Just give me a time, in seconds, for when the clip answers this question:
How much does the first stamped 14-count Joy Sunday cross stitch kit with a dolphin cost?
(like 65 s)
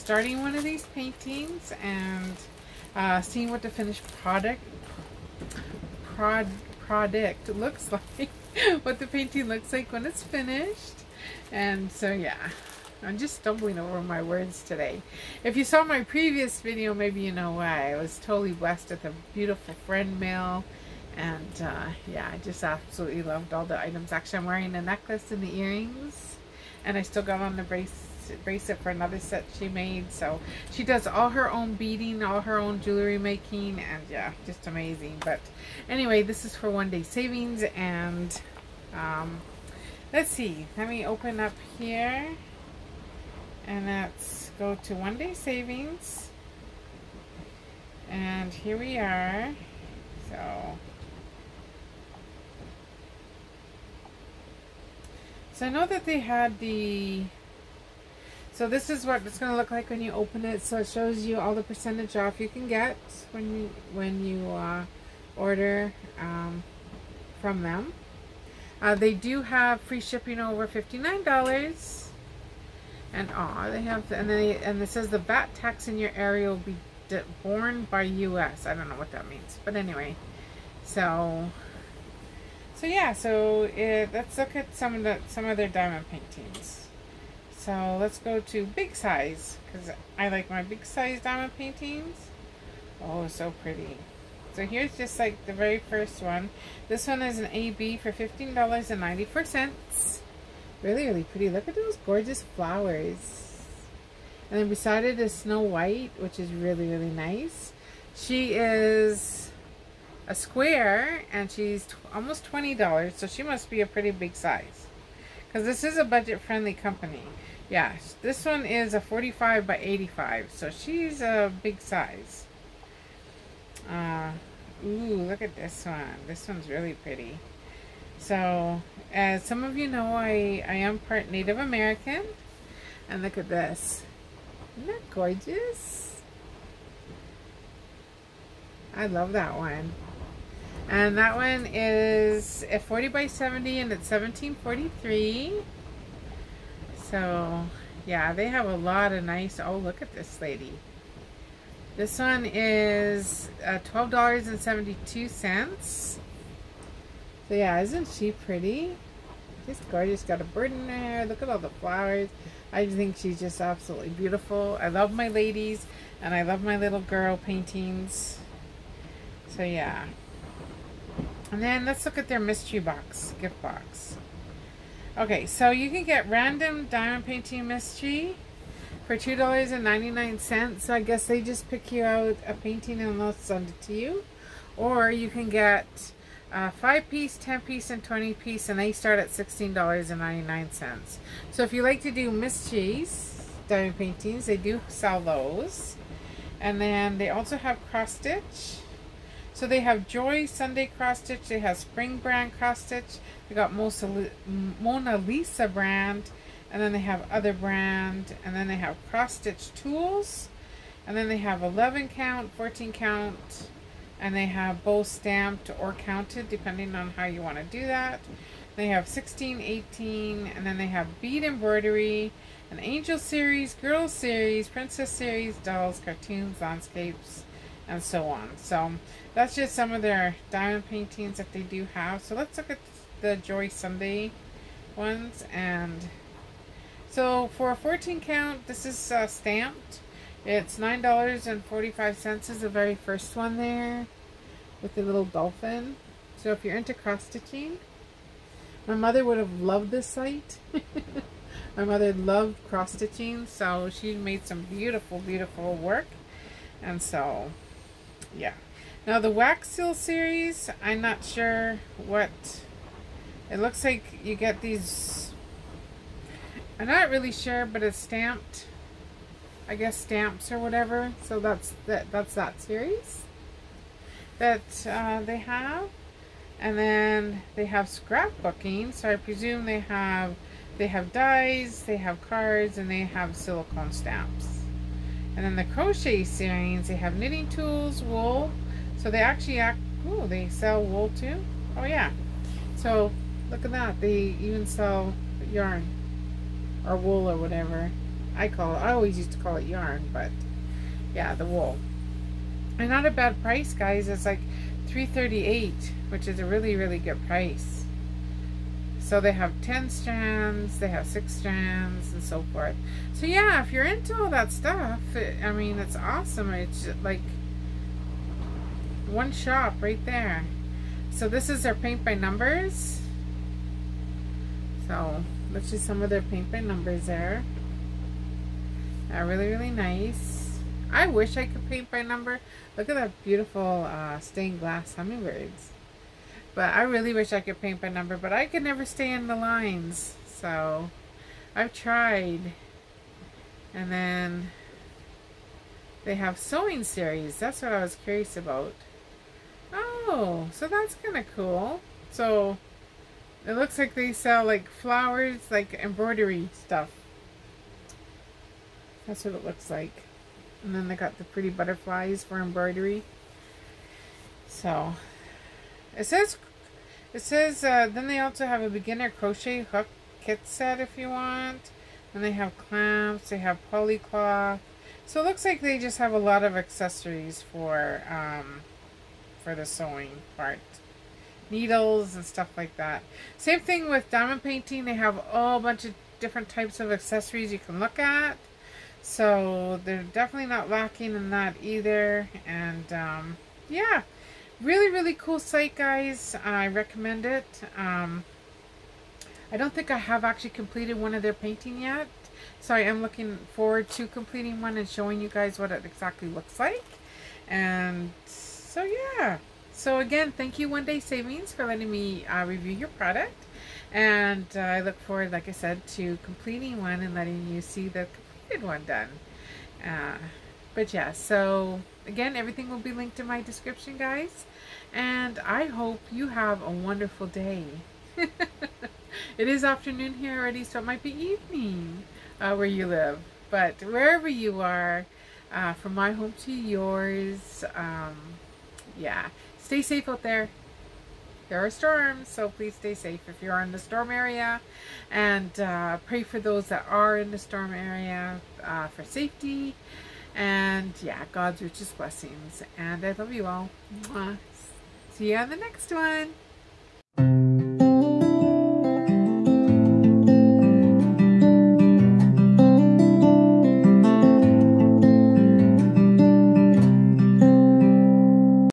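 240 s.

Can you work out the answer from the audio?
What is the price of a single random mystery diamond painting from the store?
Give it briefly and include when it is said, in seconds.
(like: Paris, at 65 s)
$2.99, at 179 s.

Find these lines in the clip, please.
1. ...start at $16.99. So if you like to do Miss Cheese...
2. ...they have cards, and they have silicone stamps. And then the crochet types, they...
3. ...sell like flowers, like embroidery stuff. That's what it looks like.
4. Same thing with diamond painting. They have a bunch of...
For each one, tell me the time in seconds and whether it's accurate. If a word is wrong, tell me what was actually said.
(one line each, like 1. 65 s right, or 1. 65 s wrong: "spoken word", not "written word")
1. 188 s right
2. 281 s wrong: "series", not "types"
3. 354 s right
4. 383 s right.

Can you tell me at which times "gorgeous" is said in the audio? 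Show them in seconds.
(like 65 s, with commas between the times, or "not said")
102 s, 135 s, 159 s.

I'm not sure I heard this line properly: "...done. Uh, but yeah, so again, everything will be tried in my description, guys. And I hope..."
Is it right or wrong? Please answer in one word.
wrong.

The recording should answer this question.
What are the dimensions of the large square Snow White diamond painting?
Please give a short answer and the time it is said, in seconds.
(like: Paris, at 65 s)
45 by 85, at 119 s.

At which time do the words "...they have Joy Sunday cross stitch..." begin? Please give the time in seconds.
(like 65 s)
199 s.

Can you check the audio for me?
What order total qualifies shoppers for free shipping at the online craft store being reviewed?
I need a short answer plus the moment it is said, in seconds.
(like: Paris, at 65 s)
$59, at 70 s.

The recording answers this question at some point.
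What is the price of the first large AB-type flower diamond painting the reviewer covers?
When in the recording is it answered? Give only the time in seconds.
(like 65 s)
98 s.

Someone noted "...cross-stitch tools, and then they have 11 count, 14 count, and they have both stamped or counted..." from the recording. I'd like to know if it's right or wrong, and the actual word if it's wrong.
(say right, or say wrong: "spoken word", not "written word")
right.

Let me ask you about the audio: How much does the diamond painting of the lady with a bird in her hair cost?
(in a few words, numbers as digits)
$12.72.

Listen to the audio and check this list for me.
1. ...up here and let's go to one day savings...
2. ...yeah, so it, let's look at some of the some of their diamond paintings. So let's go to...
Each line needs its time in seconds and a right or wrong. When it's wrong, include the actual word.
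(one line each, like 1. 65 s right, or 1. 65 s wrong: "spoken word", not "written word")
1. 41 s right
2. 82 s right.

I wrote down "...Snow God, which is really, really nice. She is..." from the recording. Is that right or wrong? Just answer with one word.
wrong.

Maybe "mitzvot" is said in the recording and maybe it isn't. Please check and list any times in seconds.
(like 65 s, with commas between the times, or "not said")
not said.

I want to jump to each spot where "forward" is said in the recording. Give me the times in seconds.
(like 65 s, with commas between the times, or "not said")
403 s, 415 s.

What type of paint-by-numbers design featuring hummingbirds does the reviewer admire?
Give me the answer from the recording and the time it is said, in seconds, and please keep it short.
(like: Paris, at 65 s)
stained glass, at 334 s.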